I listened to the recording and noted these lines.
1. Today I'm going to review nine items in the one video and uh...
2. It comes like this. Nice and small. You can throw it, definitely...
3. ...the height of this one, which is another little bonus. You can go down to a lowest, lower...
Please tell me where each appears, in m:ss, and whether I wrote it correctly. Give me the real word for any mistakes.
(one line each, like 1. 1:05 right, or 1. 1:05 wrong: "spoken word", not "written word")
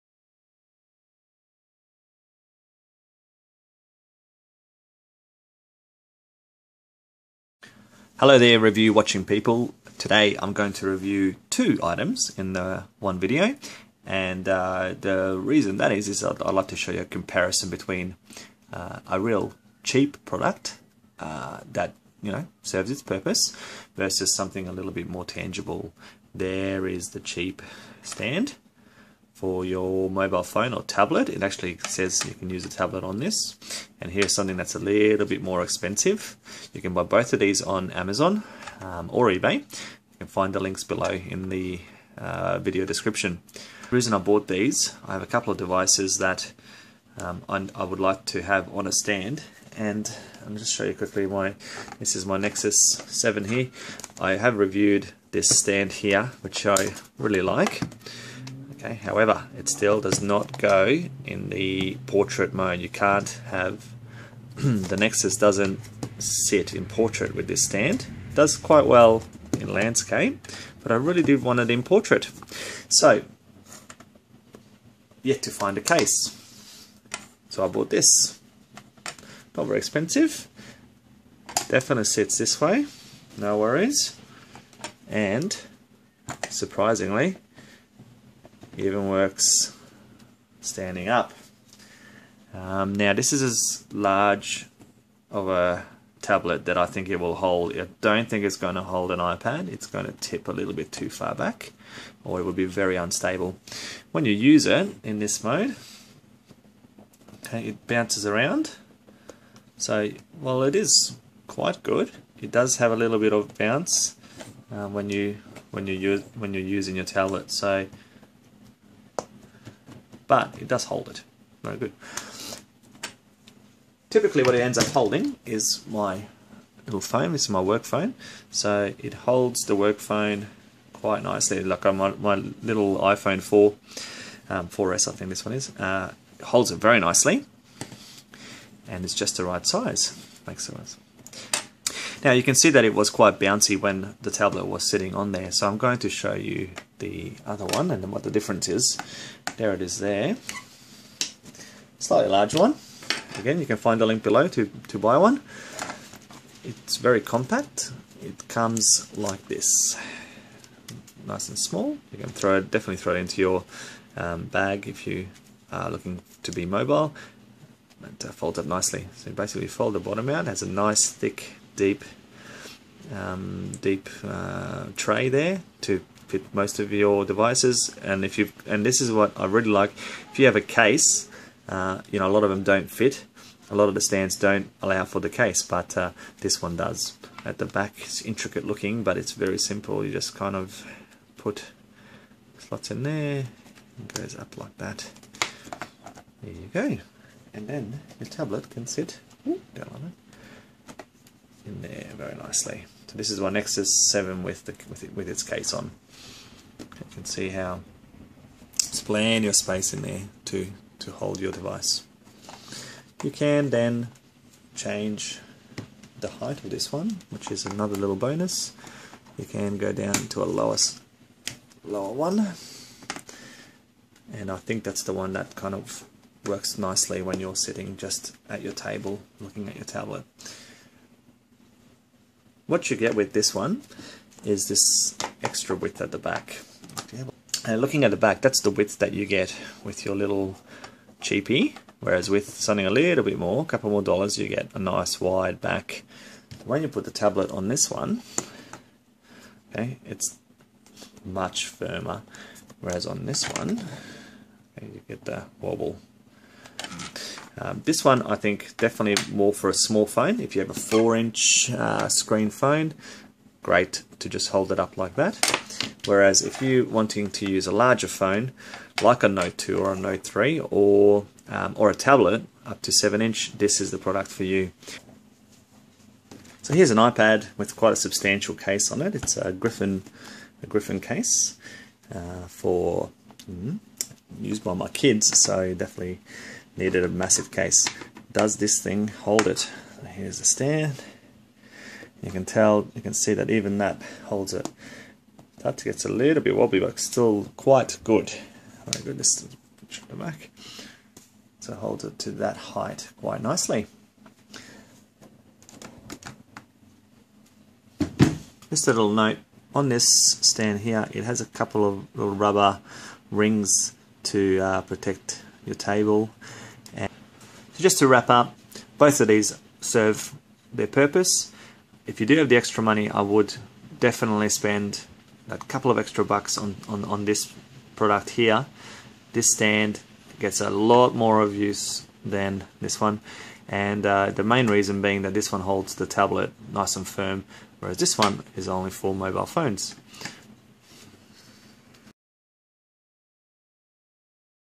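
1. 0:09 wrong: "two", not "nine"
2. 2:38 right
3. 3:36 right.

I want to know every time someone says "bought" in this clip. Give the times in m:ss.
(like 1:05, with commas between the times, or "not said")
0:44, 1:17.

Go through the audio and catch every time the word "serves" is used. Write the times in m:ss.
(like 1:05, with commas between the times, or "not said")
0:22, 5:19.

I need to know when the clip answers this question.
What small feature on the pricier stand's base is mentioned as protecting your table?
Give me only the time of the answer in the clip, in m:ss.
5:12.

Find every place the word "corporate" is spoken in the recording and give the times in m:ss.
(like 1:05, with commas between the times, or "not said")
not said.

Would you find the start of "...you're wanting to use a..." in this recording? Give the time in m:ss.
4:26.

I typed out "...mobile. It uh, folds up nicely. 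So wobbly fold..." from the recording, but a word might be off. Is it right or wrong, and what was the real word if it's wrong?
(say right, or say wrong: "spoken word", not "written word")
wrong: "basically", not "wobbly".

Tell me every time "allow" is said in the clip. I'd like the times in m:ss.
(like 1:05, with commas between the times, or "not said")
3:04.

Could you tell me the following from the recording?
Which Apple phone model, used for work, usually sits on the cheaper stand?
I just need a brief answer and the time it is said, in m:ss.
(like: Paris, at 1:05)
iPhone 4S, at 2:12.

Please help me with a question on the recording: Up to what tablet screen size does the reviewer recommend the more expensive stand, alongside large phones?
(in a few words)
7 inch.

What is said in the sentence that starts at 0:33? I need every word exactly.
And here's something that's a little bit more expensive.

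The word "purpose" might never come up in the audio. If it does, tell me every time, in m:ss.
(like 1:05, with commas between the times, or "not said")
0:23, 5:20.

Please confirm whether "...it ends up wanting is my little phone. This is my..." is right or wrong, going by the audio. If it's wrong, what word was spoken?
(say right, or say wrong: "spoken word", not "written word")
wrong: "holding", not "wanting".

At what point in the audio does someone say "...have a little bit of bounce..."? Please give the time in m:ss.
1:52.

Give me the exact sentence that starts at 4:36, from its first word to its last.
So here's an iPad with quite a substantial case on it.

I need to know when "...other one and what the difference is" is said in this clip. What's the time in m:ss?
2:27.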